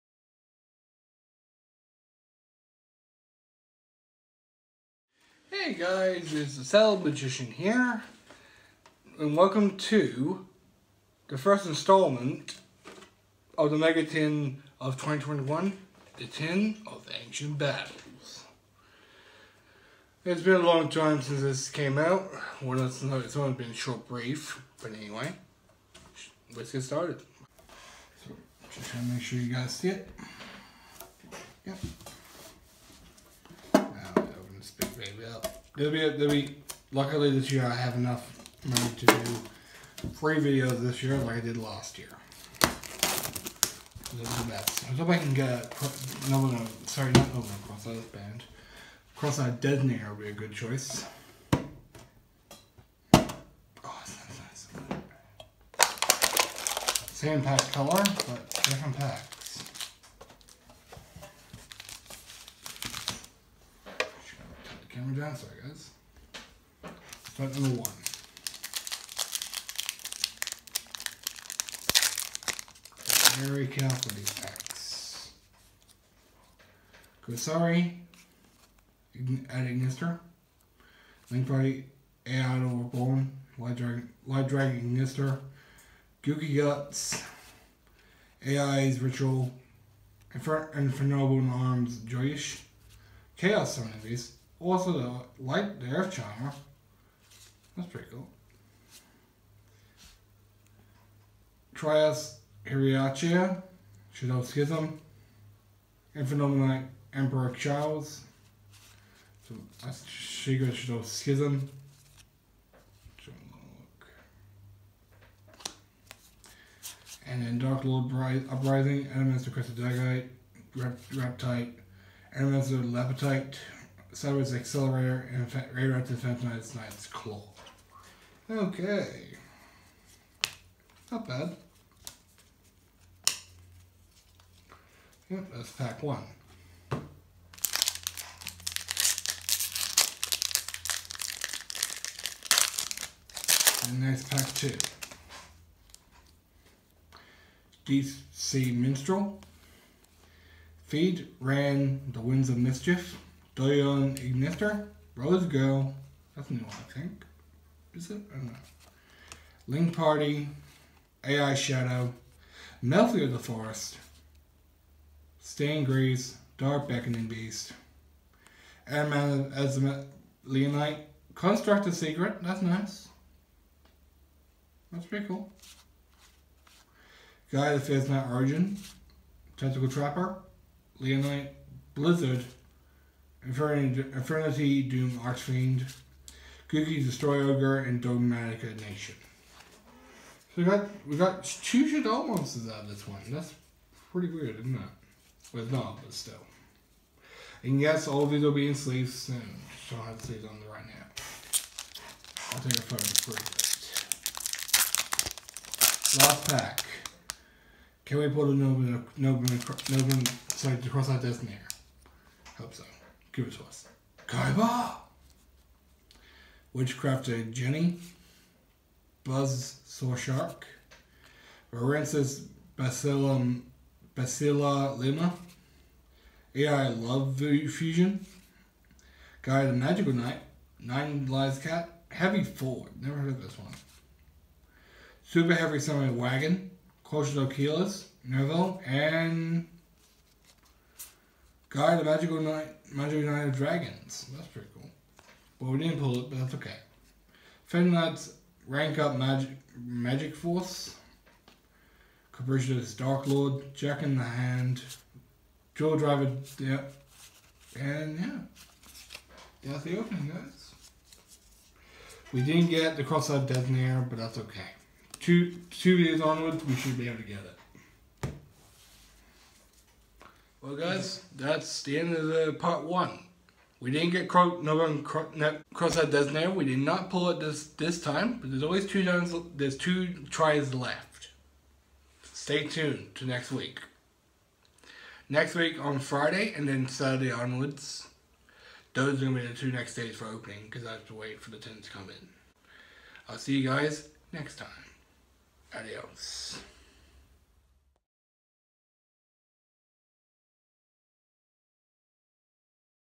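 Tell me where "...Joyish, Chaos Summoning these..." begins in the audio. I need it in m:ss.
1:32.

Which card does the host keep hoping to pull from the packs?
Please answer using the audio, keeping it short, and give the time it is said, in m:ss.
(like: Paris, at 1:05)
Crossout Designator, at 0:49.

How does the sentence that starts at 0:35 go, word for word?
There'll be, there'll be, luckily this year I have enough money to do free videos this year like I did last year.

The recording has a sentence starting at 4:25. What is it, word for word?
Two two videos onwards, we should be able to get it.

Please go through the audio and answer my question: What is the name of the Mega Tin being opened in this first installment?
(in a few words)
Tin of Ancient Battles.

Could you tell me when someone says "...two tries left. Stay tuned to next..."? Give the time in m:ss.
4:39.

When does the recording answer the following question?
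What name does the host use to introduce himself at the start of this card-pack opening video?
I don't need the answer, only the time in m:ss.
0:06.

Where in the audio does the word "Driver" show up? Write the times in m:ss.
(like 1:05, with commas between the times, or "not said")
4:15.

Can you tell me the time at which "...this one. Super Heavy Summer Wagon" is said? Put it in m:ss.
3:53.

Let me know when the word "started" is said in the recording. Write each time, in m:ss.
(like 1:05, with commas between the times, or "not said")
0:26.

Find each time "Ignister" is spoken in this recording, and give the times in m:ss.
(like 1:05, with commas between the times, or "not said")
1:19, 1:24, 2:34.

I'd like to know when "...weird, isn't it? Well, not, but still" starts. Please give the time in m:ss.
3:14.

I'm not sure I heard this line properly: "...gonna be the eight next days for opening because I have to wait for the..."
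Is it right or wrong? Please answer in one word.
wrong.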